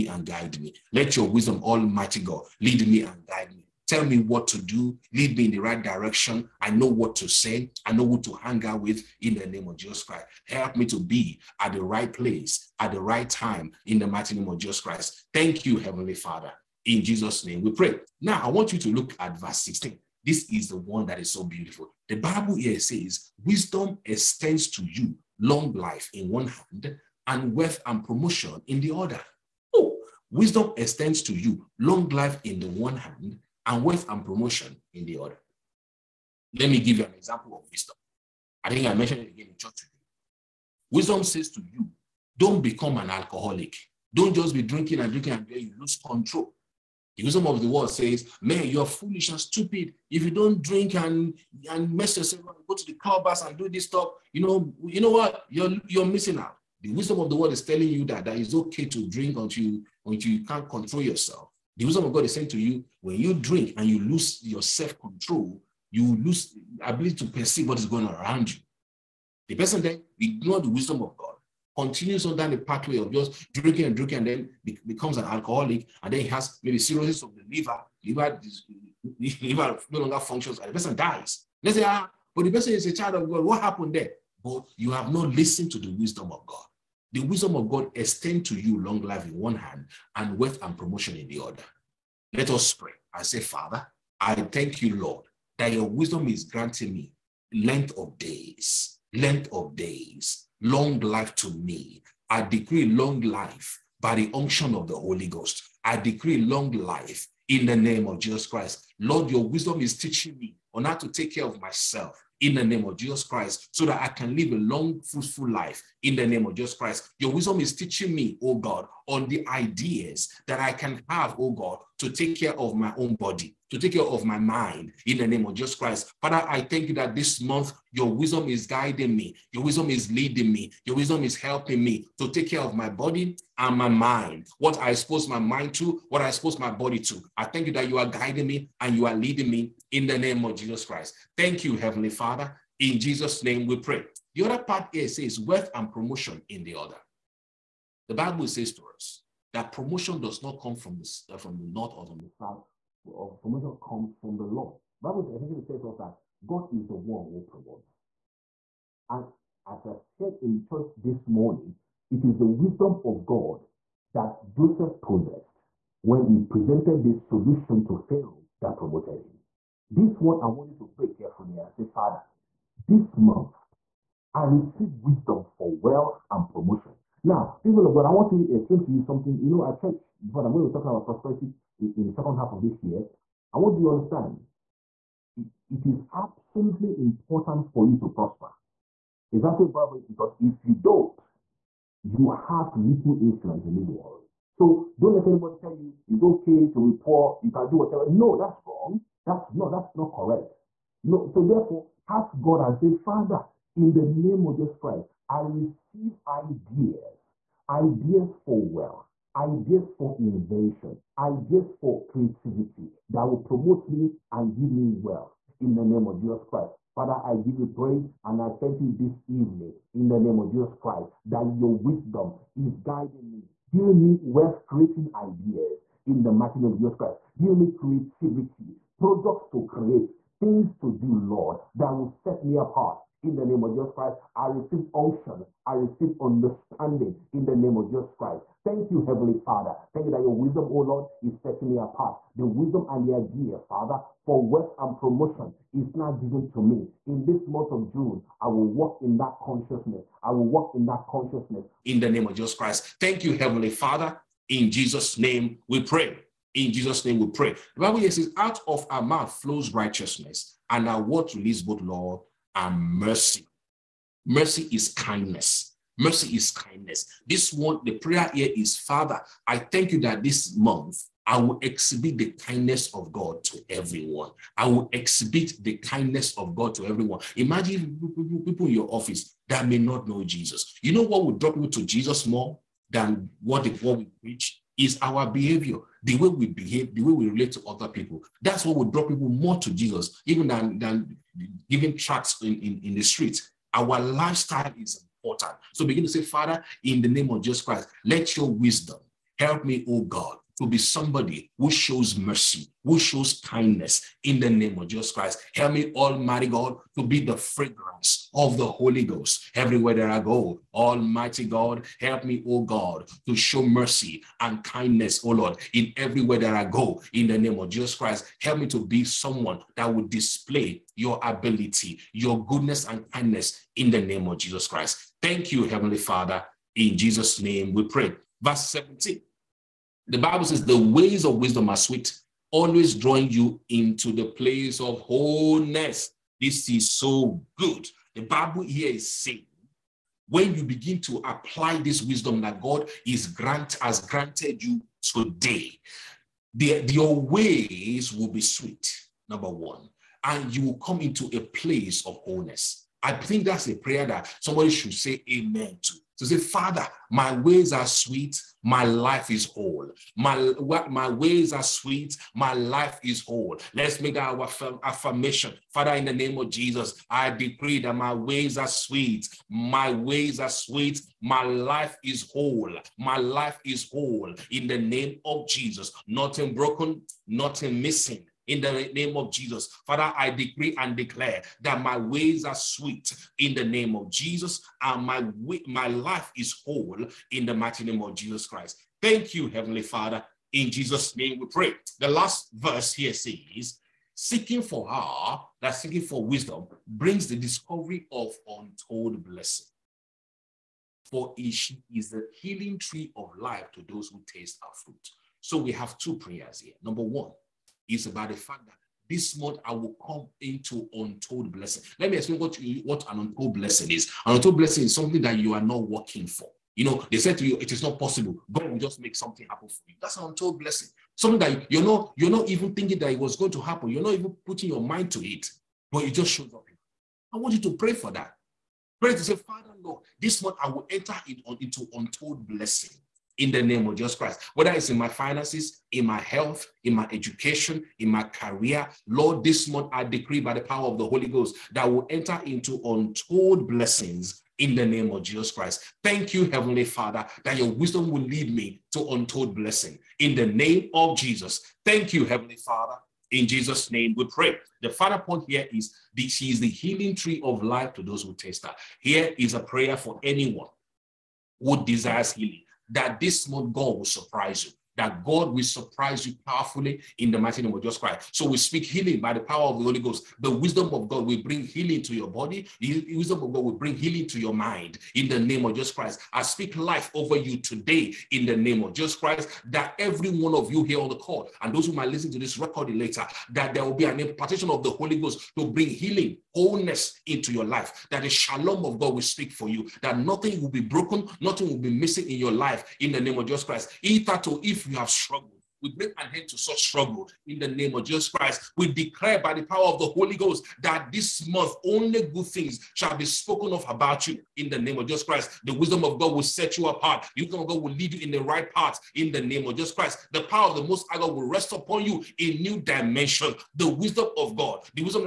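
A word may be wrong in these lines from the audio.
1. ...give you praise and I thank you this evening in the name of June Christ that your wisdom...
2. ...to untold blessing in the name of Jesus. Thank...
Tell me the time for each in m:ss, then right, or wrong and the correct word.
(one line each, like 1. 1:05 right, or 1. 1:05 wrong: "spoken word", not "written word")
1. 3:37 wrong: "Jesus", not "June"
2. 7:28 right.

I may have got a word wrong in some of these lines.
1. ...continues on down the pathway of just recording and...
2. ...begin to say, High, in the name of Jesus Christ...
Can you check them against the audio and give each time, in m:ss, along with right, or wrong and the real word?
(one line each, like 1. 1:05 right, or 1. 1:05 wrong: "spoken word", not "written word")
1. 1:11 wrong: "drinking", not "recording"
2. 4:55 wrong: "Father", not "High".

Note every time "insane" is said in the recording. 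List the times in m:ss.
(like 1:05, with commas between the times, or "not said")
not said.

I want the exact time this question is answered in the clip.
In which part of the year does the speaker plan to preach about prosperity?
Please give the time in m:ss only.
3:02.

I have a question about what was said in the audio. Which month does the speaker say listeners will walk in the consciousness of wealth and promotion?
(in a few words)
June.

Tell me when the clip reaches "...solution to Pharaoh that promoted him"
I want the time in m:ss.
2:47.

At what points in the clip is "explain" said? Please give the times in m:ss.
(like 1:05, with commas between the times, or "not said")
2:58, 6:52.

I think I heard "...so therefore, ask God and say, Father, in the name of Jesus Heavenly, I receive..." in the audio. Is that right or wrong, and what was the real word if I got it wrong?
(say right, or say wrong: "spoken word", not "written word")
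wrong: "Christ", not "Heavenly".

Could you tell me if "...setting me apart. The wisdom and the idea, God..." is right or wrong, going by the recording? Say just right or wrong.
wrong.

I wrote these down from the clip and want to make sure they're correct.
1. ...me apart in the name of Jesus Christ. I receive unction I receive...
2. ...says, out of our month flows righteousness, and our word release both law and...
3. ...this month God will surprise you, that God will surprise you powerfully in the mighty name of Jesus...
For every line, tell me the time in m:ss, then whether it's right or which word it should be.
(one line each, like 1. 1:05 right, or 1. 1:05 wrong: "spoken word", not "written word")
1. 3:52 right
2. 4:18 wrong: "mouth", not "month"
3. 7:43 right.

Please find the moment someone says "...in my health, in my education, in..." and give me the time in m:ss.
7:15.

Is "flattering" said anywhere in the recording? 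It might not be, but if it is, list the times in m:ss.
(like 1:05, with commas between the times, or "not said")
not said.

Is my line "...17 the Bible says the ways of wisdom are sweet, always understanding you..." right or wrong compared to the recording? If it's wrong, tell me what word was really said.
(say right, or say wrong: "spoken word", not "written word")
wrong: "drawing", not "understanding".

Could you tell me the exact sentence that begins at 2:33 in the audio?
Of promotion comes from the Lord.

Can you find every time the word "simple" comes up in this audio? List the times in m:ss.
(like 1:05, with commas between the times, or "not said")
not said.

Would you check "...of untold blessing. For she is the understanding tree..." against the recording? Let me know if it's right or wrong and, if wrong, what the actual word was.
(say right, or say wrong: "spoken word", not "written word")
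wrong: "healing", not "understanding".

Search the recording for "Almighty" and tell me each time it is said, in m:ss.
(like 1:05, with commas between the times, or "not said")
0:01, 5:05, 5:10.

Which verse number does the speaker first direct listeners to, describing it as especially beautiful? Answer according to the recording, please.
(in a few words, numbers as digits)
16.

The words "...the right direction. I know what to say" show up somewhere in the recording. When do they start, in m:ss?
0:05.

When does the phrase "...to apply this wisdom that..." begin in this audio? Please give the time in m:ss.
5:41.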